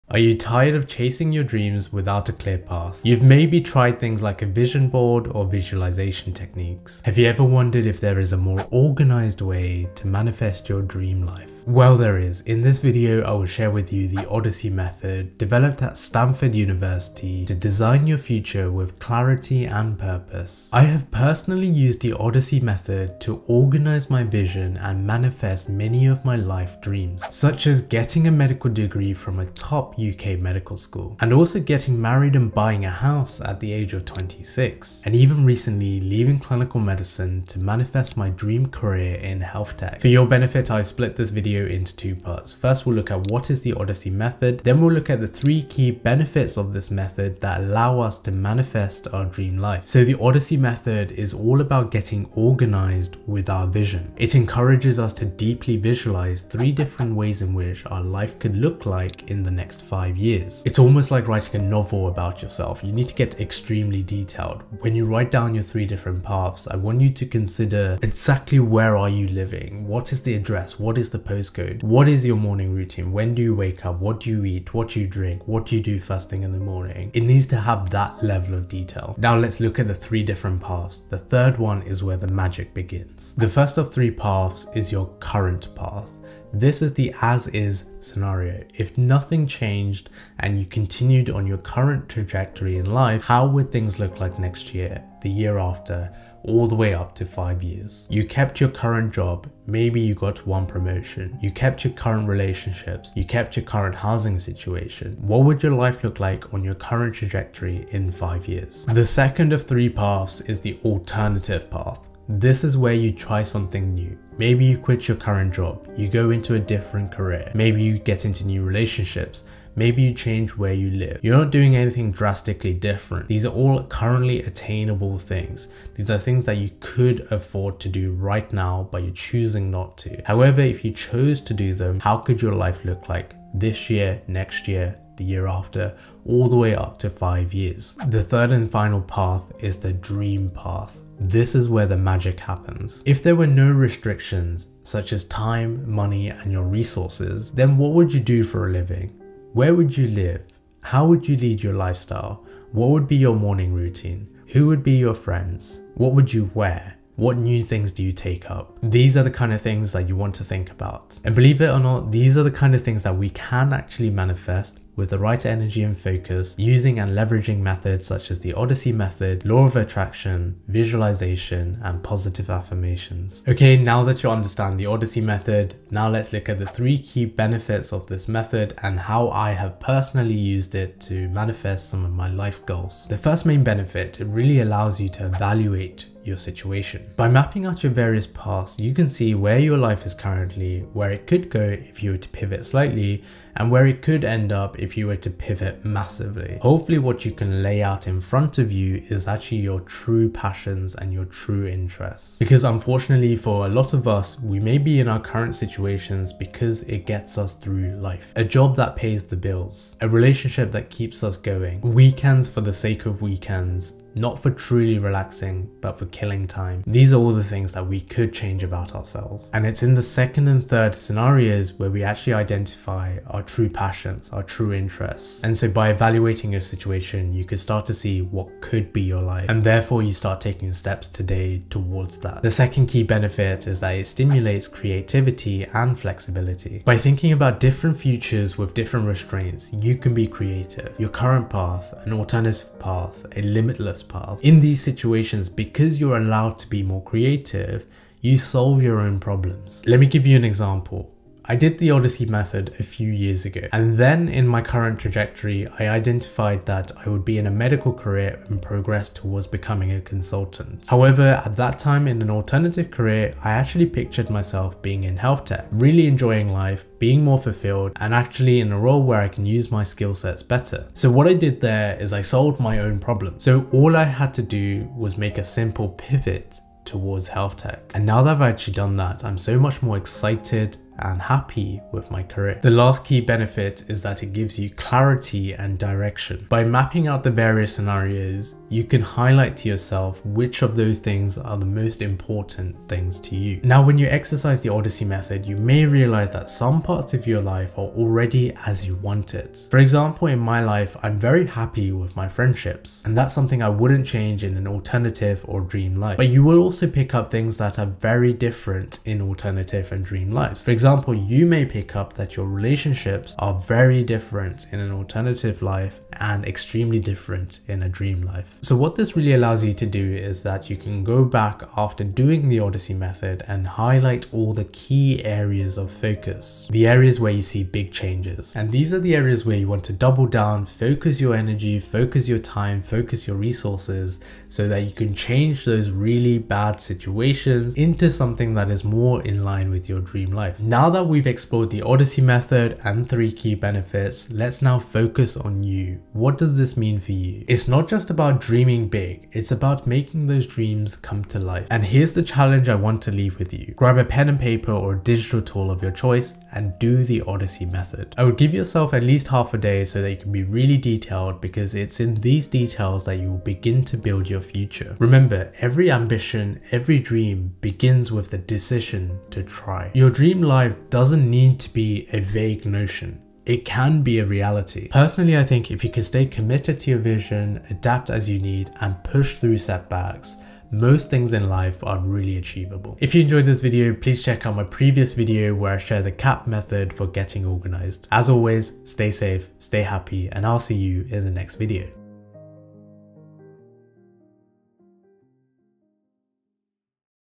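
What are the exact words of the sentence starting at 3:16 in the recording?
Hopefully what you can lay out in front of you is actually your true passions and your true interests.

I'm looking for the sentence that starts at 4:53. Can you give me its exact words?
Now, when you exercise the Odyssey method, you may realize that some parts of your life are already as you want it.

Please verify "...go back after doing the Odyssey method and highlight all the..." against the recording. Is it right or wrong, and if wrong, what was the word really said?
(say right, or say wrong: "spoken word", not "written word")
right.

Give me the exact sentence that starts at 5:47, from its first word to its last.
It's not just about dreaming big, it's about making those dreams come to life.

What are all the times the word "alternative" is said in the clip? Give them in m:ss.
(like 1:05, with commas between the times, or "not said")
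1:50, 4:02, 4:22, 5:04, 5:09, 5:14.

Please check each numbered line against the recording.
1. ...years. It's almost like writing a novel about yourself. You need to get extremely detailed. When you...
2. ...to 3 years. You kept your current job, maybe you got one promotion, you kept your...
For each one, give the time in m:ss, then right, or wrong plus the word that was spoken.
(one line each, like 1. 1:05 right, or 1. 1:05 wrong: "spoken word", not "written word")
1. 1:00 right
2. 1:37 wrong: "5", not "3".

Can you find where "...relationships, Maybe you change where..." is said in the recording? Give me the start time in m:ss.
1:58.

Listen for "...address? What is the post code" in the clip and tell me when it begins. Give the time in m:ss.
1:10.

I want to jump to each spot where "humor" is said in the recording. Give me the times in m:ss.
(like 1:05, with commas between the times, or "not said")
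not said.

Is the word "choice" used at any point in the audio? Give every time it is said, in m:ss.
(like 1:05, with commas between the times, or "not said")
5:55.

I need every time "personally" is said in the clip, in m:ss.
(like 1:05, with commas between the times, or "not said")
0:21, 2:59, 6:14.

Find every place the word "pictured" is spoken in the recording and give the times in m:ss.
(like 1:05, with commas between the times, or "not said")
4:23.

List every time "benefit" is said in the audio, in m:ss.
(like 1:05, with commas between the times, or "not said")
0:40, 0:45, 2:57, 3:03, 3:53, 4:43, 5:43.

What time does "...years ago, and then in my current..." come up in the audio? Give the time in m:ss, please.
4:13.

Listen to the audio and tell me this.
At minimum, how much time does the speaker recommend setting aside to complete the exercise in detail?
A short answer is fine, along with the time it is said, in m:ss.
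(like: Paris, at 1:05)
half a day, at 5:59.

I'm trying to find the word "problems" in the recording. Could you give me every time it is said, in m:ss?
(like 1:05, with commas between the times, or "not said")
4:09, 4:32.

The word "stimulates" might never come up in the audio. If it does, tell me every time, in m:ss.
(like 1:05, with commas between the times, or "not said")
3:54.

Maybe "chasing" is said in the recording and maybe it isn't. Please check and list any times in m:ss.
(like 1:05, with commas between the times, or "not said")
0:00.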